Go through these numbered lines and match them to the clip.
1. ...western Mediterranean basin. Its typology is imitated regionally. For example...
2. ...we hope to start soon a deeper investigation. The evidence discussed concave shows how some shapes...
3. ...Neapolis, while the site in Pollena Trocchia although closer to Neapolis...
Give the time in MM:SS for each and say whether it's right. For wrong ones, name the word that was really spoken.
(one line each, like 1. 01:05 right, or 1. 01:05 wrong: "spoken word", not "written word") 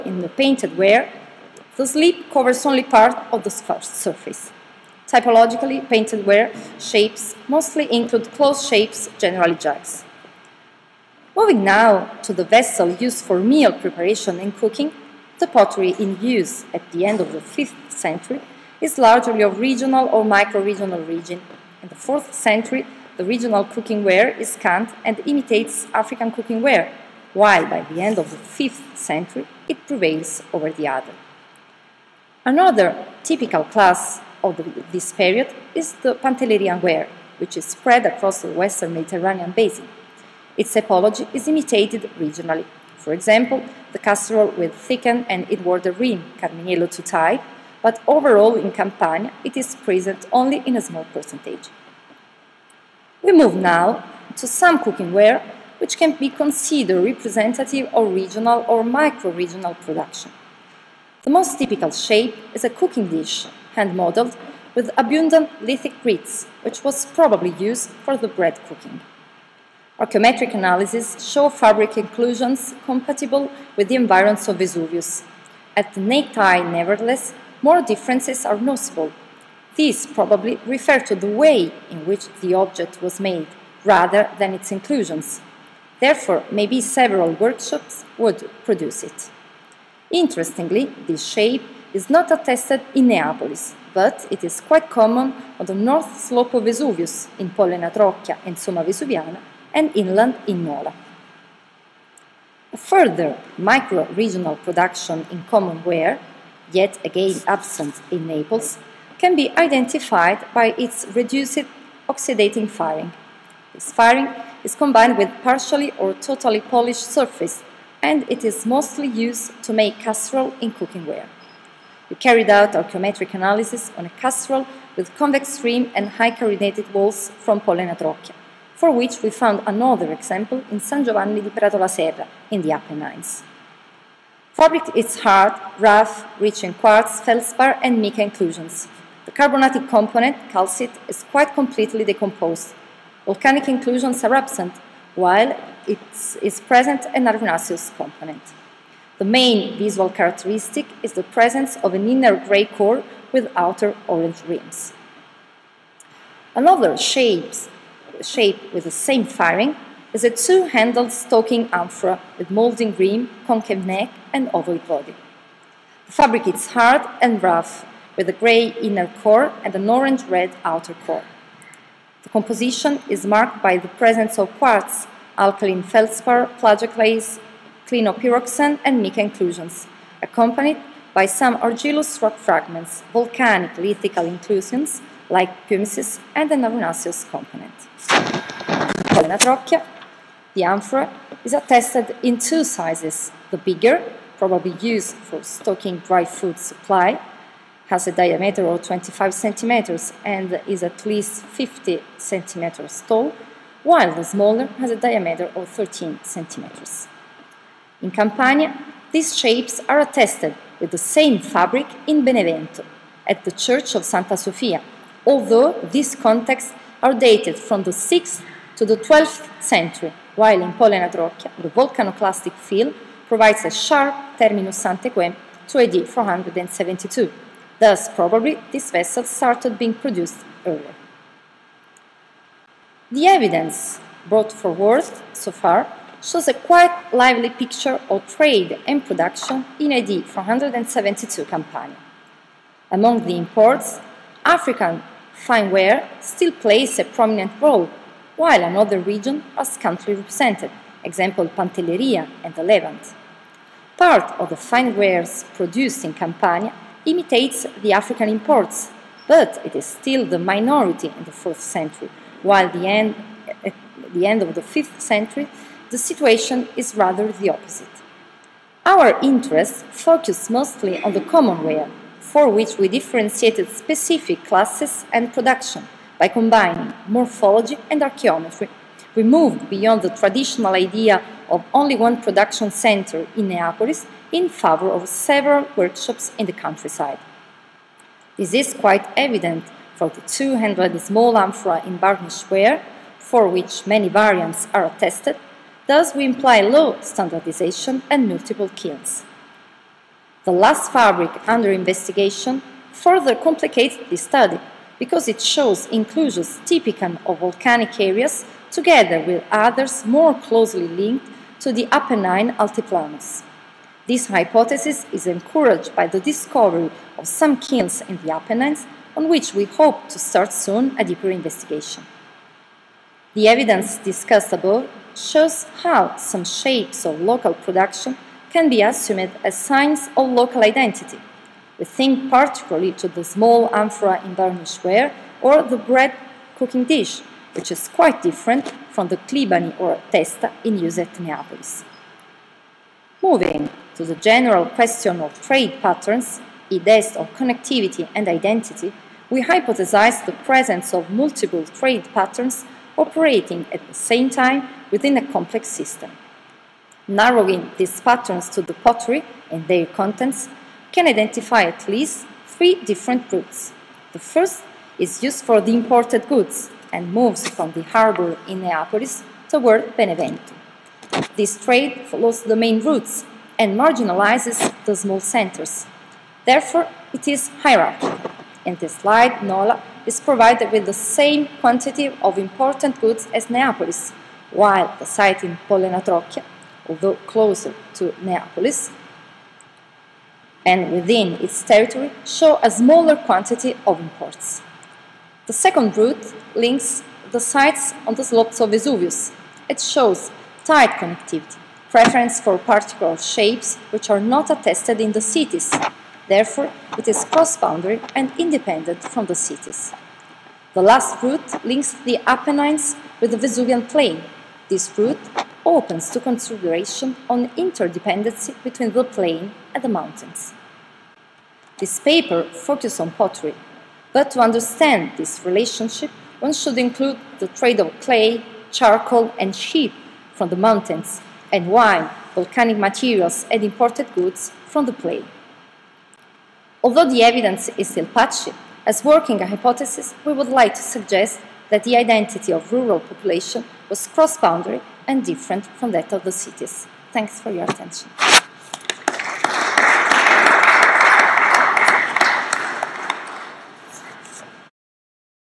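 1. 00:38 right
2. 05:19 wrong: "above", not "concave"
3. 06:23 right.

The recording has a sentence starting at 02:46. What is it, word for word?
The fabric is hard and rough with a grey inner core and an orange-red outer core.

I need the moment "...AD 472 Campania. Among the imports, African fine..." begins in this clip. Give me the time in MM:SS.
03:59.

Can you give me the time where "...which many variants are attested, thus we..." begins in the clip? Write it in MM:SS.
04:53.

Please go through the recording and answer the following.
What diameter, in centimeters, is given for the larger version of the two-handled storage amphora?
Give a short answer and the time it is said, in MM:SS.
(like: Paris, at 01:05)
25 centimeters, at 03:18.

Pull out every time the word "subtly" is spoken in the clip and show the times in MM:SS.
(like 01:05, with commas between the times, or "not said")
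not said.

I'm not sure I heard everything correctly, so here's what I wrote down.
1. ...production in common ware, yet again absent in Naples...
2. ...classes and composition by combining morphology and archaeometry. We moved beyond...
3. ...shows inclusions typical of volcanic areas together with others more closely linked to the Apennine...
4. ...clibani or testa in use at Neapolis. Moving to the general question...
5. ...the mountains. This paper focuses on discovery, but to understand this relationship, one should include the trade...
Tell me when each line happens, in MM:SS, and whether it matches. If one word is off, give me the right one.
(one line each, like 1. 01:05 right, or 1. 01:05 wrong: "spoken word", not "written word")
1. 01:44 right
2. 04:34 wrong: "production", not "composition"
3. 05:05 right
4. 05:39 right
5. 06:59 wrong: "pottery", not "discovery".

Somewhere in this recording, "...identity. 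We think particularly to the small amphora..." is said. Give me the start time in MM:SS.
05:30.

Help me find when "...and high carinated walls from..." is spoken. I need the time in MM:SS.
02:05.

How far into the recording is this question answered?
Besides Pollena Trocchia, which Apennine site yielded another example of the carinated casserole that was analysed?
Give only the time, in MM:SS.
02:10.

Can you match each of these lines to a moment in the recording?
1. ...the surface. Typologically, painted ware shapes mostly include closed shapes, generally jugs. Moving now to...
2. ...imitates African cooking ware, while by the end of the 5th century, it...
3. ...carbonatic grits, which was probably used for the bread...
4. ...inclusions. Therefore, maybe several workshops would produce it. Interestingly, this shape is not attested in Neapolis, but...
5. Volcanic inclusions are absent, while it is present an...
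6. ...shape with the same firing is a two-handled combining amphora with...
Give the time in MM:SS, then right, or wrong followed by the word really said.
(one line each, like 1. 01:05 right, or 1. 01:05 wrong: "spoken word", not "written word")
1. 00:03 right
2. 00:25 right
3. 01:05 wrong: "lithic", not "carbonatic"
4. 01:24 right
5. 02:23 right
6. 02:38 wrong: "stalking", not "combining".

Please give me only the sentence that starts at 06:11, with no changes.
This trade follows the main routes and marginalizes the small centers.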